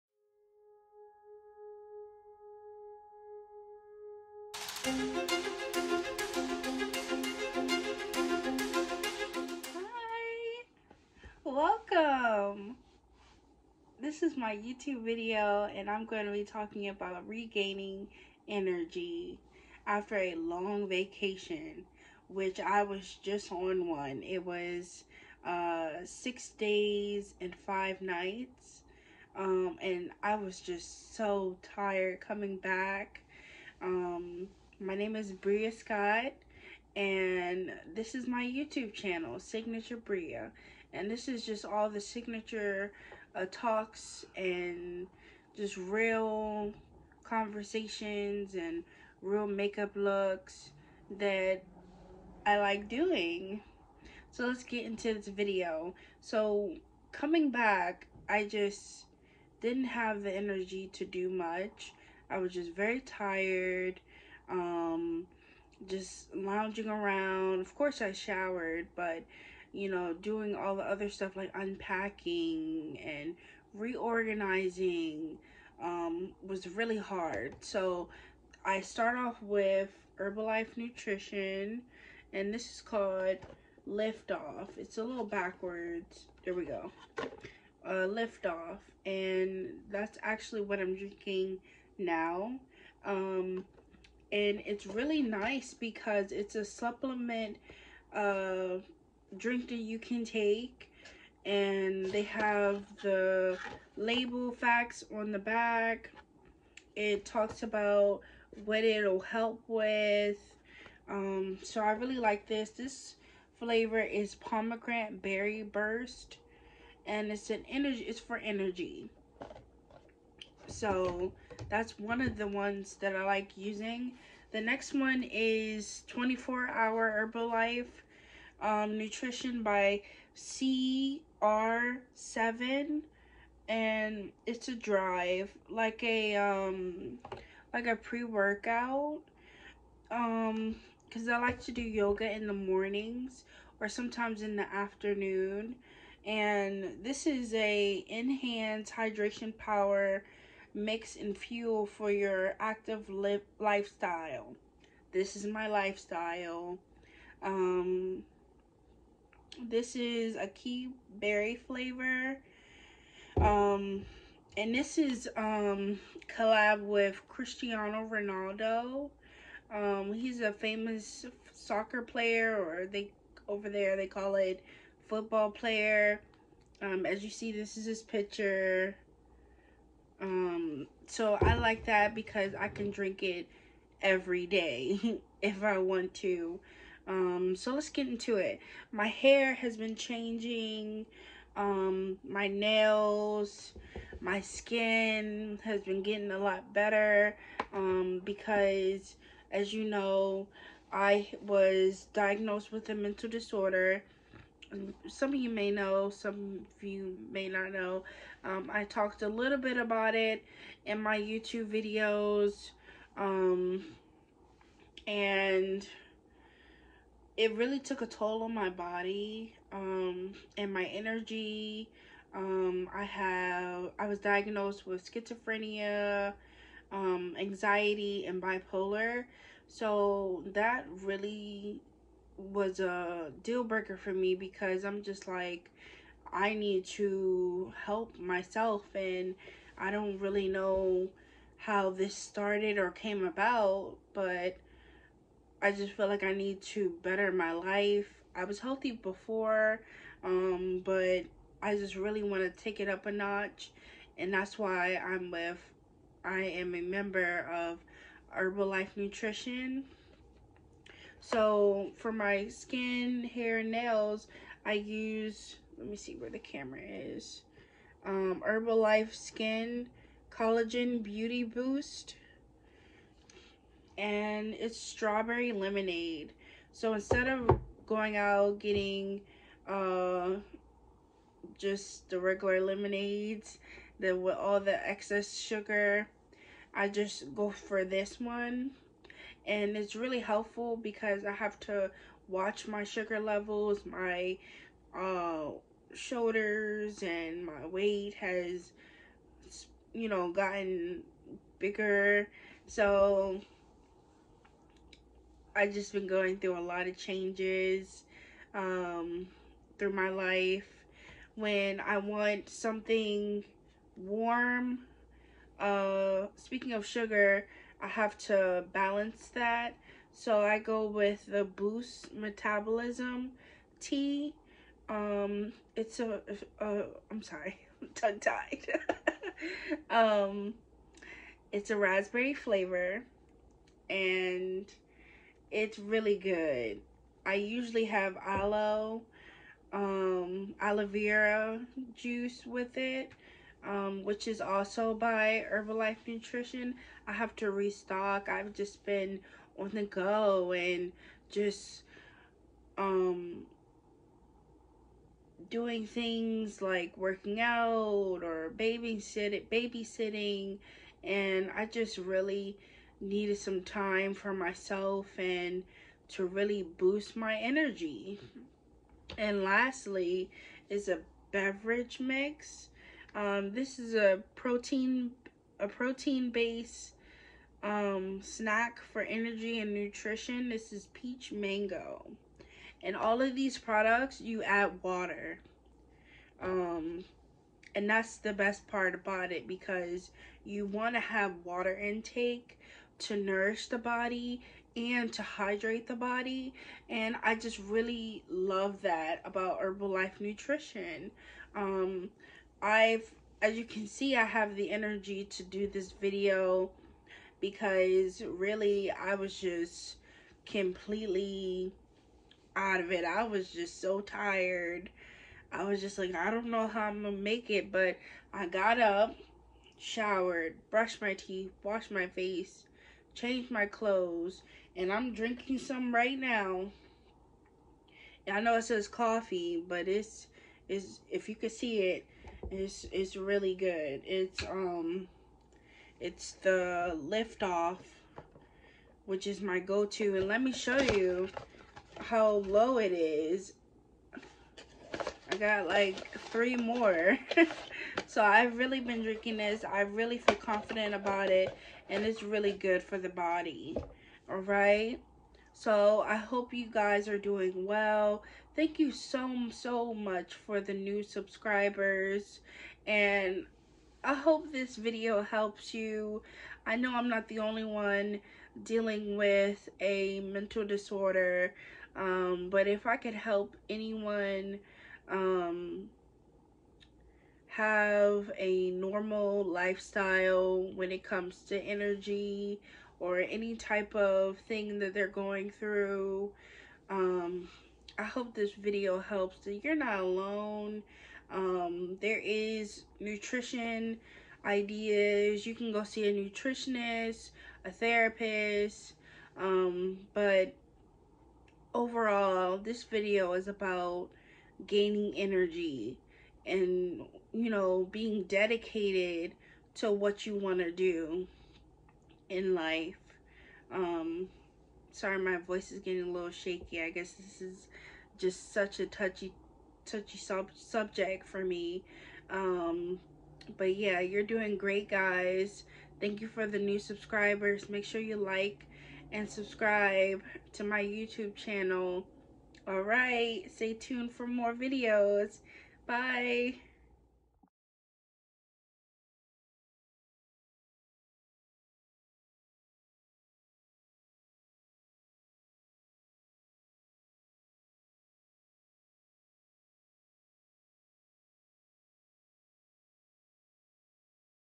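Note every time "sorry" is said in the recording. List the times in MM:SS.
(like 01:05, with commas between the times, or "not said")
05:27, 08:34.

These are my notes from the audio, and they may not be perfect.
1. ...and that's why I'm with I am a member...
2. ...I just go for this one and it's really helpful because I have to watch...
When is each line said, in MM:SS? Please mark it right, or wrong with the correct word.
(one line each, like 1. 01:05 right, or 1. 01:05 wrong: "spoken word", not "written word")
1. 04:14 right
2. 04:46 right.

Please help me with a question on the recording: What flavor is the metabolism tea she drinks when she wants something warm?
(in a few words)
raspberry.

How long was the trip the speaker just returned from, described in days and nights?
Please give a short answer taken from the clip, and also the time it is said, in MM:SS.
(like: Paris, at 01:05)
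six days and five nights, at 00:26.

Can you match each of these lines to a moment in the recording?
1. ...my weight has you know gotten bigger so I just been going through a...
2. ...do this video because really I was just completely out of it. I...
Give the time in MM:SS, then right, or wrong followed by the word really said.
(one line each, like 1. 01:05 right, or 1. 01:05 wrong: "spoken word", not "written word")
1. 04:57 right
2. 06:45 right.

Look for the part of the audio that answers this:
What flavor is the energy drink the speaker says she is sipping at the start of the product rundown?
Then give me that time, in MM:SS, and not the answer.
01:54.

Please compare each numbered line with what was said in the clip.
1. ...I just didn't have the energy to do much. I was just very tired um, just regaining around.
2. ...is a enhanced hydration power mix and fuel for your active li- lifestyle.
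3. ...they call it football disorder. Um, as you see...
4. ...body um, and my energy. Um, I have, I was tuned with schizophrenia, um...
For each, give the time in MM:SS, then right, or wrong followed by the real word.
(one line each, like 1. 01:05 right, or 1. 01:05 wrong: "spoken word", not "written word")
1. 00:58 wrong: "lounging", not "regaining"
2. 02:27 right
3. 02:53 wrong: "player", not "disorder"
4. 03:38 wrong: "diagnosed", not "tuned".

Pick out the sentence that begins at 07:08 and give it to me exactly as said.
I know it says coffee, but it's is if you could see it, it's it's really good.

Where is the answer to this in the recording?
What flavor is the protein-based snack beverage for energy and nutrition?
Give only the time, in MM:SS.
06:20.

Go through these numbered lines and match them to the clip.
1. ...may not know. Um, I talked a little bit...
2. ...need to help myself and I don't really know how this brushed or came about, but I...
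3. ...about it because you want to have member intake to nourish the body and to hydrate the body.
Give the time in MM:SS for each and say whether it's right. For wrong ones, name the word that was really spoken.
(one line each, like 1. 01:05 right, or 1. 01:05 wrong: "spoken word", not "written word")
1. 03:27 right
2. 03:56 wrong: "started", not "brushed"
3. 06:28 wrong: "water", not "member".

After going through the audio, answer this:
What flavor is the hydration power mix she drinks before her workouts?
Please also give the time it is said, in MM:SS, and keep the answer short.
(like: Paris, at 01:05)
açaí berry, at 02:40.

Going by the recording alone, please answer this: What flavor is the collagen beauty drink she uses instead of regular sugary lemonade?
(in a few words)
strawberry lemonade.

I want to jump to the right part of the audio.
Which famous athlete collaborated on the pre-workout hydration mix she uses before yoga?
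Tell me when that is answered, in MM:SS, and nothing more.
02:47.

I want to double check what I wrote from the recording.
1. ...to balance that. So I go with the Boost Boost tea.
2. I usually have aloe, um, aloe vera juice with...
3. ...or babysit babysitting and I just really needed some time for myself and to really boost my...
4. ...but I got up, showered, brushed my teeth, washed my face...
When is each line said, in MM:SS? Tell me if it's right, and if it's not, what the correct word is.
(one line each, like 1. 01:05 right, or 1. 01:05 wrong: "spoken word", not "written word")
1. 05:18 wrong: "Metabolism", not "Boost"
2. 05:37 right
3. 05:58 right
4. 06:57 right.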